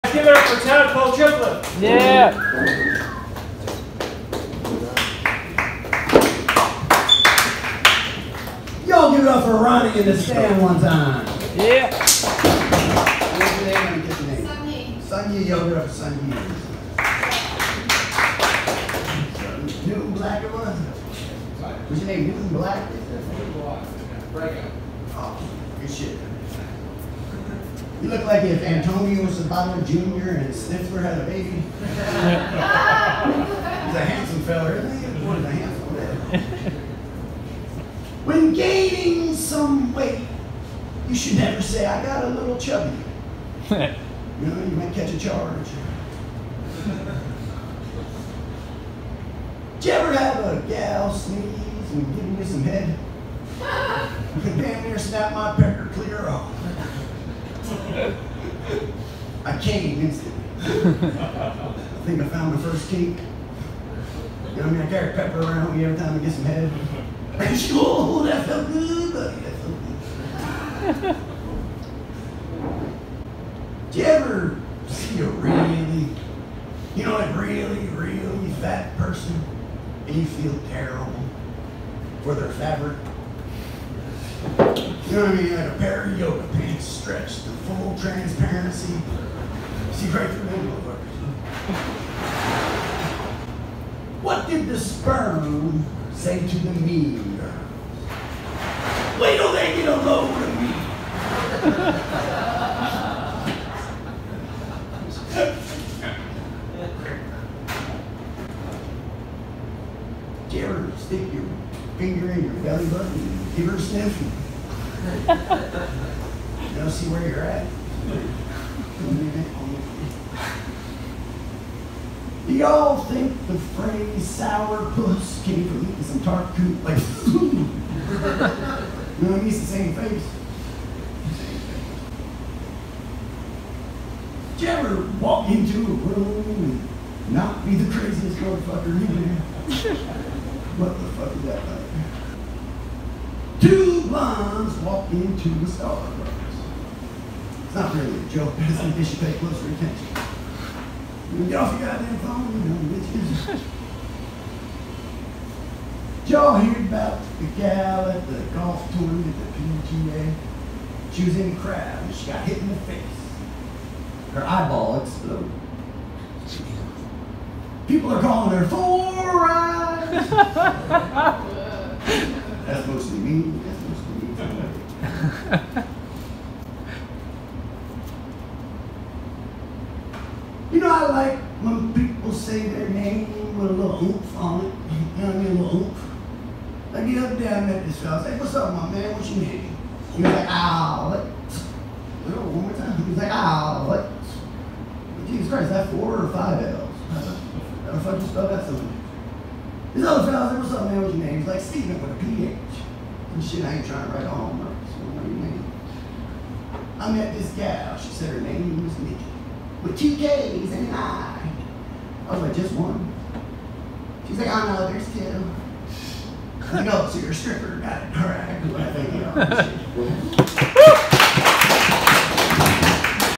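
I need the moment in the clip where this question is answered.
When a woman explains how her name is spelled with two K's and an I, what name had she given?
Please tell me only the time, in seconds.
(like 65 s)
208 s.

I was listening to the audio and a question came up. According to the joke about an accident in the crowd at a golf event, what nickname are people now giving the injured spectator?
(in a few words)
Four eyes.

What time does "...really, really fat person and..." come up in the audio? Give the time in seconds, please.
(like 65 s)
77 s.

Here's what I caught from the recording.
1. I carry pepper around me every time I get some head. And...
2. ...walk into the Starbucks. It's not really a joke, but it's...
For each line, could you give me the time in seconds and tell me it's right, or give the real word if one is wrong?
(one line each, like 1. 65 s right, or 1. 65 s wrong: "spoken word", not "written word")
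1. 64 s right
2. 144 s right.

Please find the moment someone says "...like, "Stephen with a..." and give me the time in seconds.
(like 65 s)
201 s.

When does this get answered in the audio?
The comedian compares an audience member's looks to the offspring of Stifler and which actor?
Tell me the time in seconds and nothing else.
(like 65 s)
28 s.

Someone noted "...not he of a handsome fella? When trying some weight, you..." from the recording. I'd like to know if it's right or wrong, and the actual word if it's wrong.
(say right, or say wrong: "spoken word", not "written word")
wrong: "gaining", not "trying".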